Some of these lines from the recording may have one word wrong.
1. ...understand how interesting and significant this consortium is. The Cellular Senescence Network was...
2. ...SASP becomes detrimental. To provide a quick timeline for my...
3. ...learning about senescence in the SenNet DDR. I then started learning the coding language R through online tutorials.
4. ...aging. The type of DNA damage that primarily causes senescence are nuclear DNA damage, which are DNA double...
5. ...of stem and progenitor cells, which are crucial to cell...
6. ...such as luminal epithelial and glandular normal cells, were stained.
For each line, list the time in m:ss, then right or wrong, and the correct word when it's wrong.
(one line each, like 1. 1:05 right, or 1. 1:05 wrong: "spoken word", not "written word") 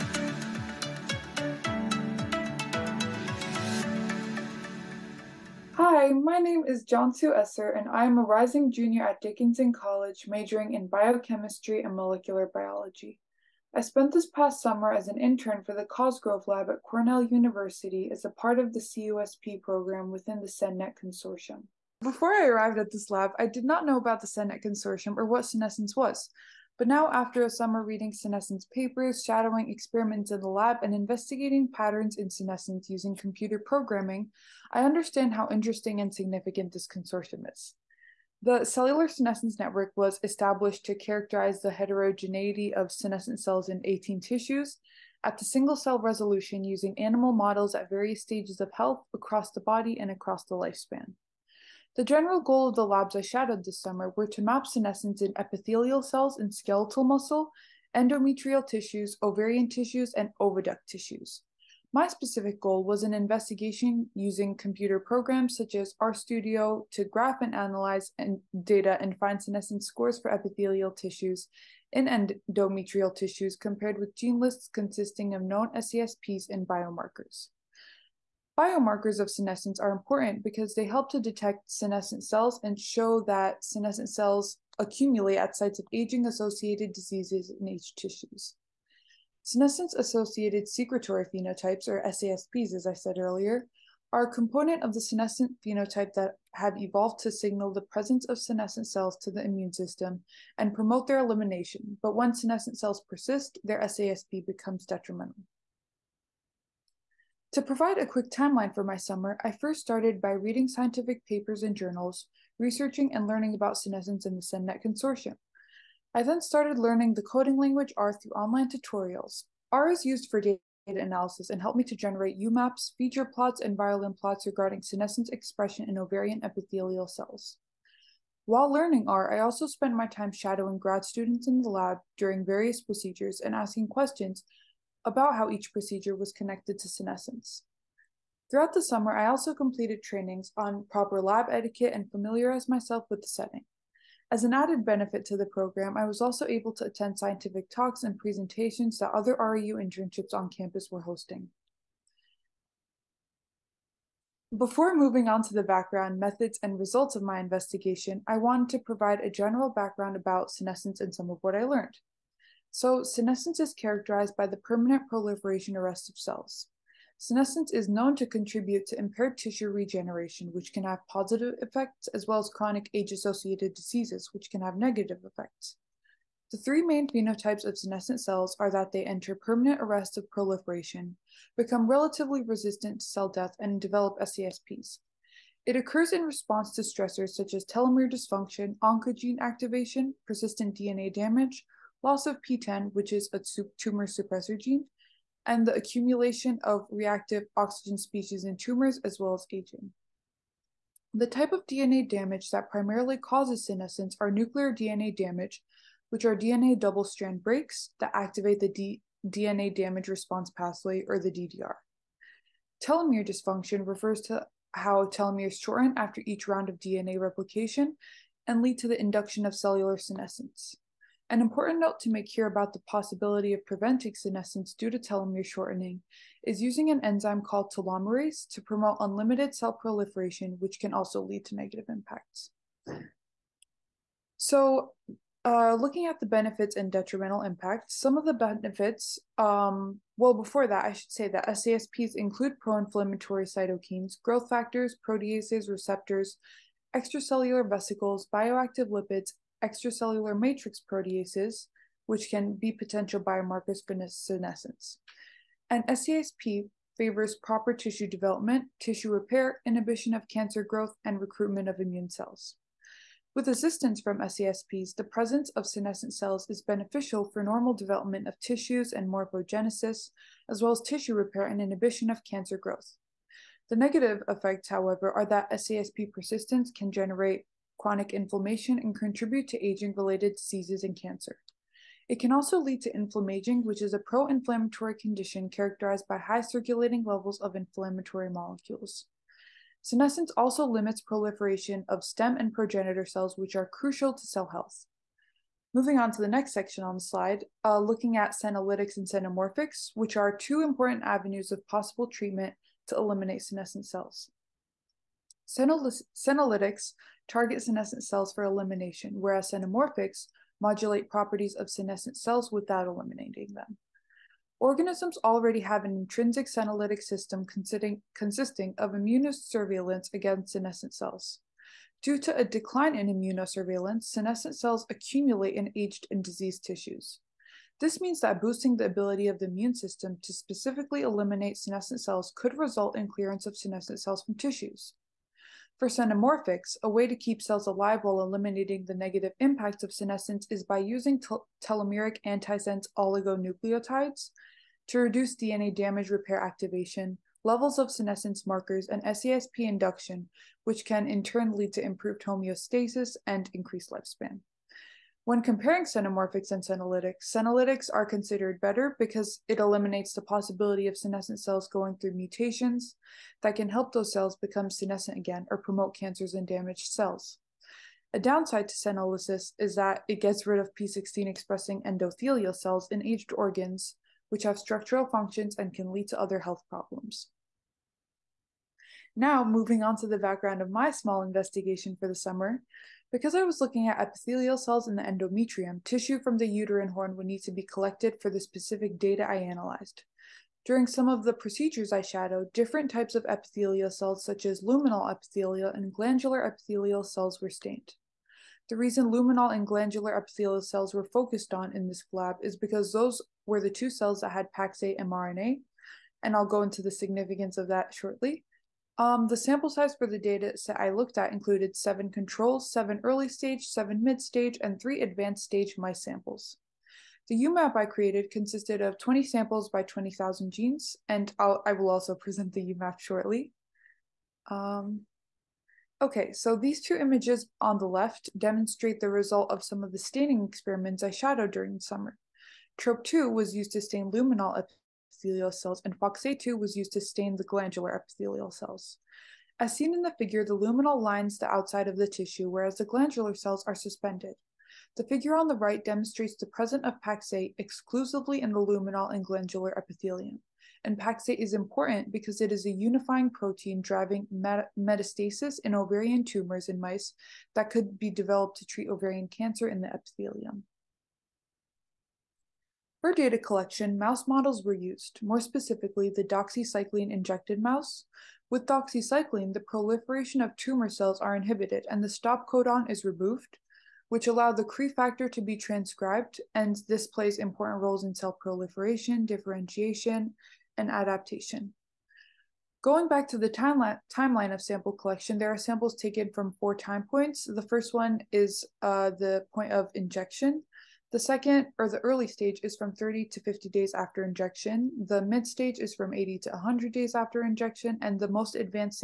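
1. 0:34 right
2. 1:43 right
3. 1:53 wrong: "Consortium", not "DDR"
4. 3:19 right
5. 4:51 right
6. 6:34 wrong: "epithelial", not "normal".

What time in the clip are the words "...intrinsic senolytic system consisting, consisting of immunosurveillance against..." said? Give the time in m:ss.
5:15.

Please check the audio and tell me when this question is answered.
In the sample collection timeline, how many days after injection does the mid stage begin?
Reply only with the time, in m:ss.
8:16.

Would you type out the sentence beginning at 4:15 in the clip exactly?
And SASP favors proper tissue development, tissue repair, inhibition of cancer growth, and recruitment of immune cells.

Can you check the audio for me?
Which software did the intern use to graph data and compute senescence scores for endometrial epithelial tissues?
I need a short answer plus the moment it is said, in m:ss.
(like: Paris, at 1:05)
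RStudio, at 1:06.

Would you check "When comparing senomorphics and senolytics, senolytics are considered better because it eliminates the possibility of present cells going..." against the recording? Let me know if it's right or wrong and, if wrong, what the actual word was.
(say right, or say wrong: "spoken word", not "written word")
wrong: "senescent", not "present".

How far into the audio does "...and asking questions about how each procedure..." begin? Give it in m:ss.
2:13.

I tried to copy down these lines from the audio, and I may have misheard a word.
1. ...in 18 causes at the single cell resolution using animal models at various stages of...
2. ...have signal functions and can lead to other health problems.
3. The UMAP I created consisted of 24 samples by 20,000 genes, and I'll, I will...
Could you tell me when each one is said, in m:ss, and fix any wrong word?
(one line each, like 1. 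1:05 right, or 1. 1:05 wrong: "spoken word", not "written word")
1. 0:43 wrong: "tissues", not "causes"
2. 6:14 wrong: "structural", not "signal"
3. 6:57 wrong: "20", not "24".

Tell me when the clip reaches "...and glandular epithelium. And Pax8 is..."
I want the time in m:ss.
7:29.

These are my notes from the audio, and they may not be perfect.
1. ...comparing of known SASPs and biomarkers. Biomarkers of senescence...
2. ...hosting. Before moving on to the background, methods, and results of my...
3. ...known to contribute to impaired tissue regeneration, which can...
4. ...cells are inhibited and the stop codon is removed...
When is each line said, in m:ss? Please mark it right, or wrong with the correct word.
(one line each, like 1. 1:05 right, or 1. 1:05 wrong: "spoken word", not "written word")
1. 1:14 wrong: "consisting", not "comparing"
2. 2:31 right
3. 2:47 right
4. 7:50 right.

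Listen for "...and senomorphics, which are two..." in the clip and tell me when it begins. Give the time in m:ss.
4:58.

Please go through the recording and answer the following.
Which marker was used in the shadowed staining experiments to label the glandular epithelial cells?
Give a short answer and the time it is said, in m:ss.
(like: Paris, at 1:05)
FOXA2, at 7:15.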